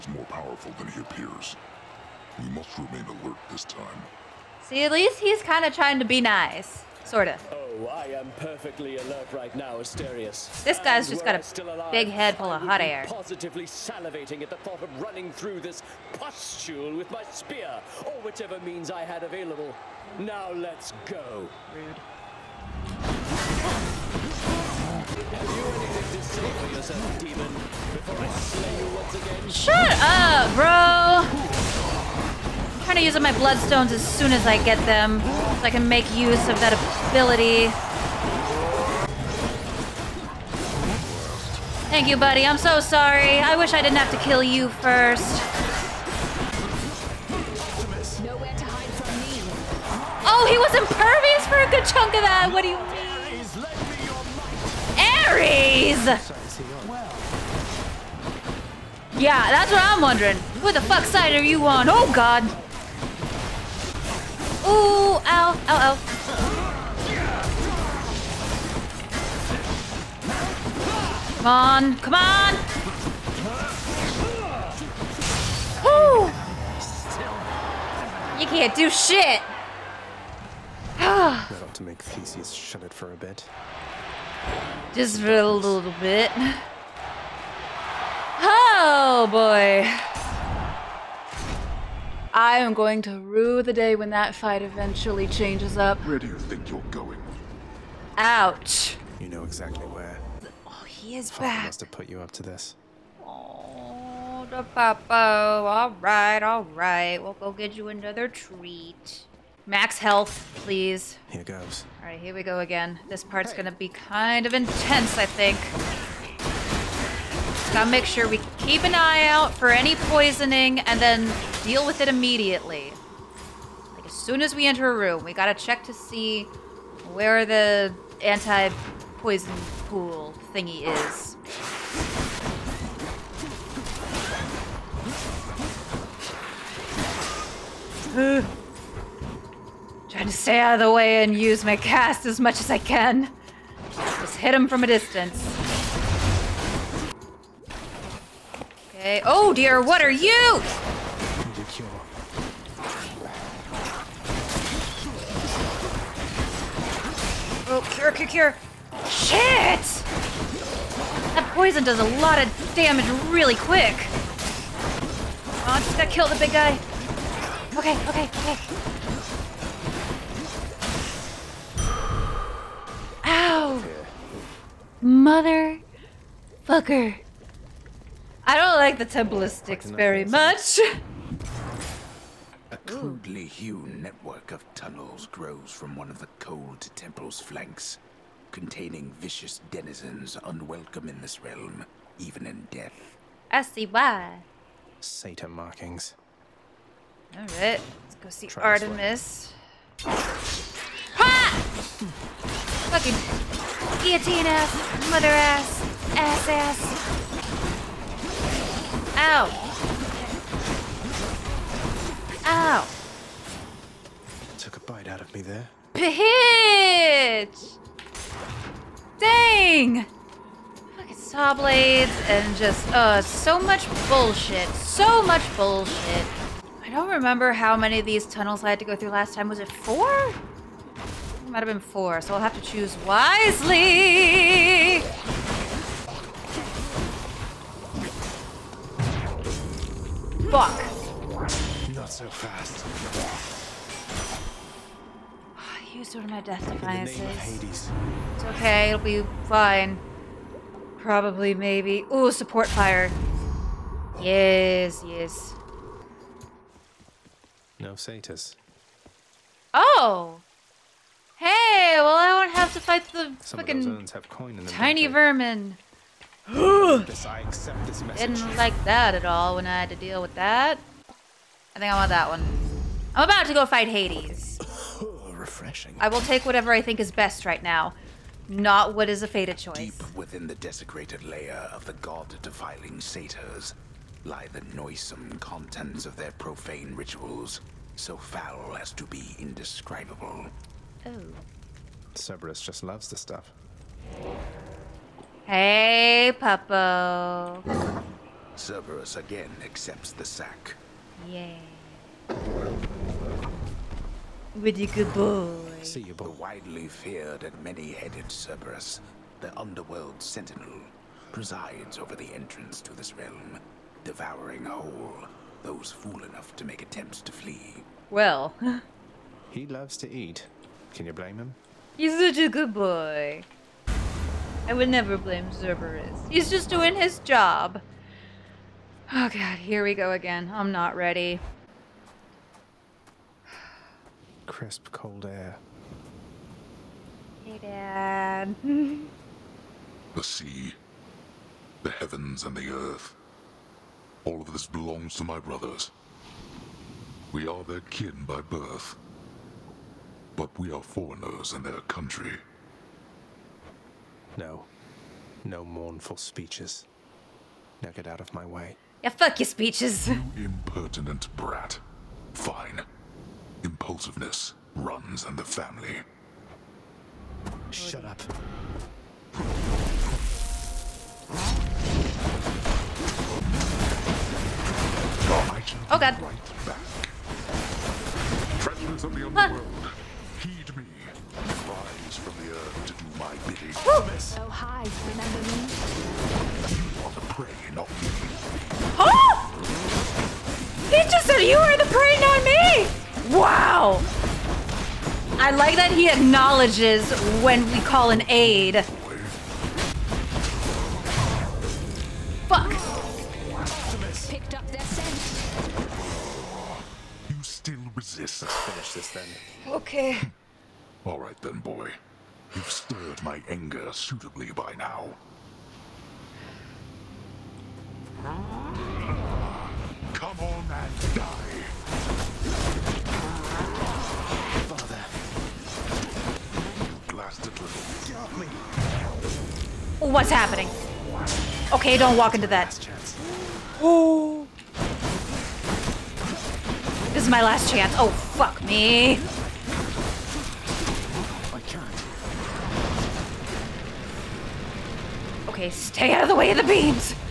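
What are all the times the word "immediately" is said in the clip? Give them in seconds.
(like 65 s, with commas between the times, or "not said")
122 s.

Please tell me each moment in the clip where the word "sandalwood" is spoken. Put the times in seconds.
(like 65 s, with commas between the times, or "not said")
not said.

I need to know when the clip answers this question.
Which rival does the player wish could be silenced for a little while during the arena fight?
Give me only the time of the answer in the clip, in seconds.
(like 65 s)
82 s.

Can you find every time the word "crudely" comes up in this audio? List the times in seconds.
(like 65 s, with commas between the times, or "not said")
182 s.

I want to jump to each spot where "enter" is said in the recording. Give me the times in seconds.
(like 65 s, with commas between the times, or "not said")
124 s.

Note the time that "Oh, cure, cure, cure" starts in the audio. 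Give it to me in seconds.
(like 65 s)
157 s.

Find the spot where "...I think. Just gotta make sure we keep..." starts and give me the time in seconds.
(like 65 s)
115 s.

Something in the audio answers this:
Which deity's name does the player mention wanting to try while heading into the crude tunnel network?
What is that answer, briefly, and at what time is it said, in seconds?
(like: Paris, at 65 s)
Artemis, at 198 s.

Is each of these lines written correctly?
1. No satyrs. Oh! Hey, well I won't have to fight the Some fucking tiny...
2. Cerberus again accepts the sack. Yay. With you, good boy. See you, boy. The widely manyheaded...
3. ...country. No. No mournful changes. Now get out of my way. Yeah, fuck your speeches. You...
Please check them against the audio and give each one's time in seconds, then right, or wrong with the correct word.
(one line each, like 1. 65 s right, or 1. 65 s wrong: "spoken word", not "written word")
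1. 257 s right
2. 298 s wrong: "feared", not "manyheaded"
3. 351 s wrong: "speeches", not "changes".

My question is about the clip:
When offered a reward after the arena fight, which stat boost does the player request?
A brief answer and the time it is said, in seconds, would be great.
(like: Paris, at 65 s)
Max health, at 109 s.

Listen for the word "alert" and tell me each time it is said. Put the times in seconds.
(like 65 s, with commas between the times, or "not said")
3 s, 8 s.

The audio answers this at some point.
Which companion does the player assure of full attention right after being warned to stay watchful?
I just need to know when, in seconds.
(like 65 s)
9 s.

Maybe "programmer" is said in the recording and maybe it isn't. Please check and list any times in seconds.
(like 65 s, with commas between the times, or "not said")
not said.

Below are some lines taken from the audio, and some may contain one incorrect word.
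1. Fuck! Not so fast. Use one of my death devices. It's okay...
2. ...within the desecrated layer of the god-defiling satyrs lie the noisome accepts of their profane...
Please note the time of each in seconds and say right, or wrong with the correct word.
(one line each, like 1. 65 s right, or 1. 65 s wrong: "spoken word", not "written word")
1. 240 s right
2. 280 s wrong: "contents", not "accepts".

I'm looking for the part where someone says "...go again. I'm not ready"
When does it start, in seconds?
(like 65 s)
329 s.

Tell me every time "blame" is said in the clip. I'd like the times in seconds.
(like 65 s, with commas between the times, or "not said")
321 s, 325 s.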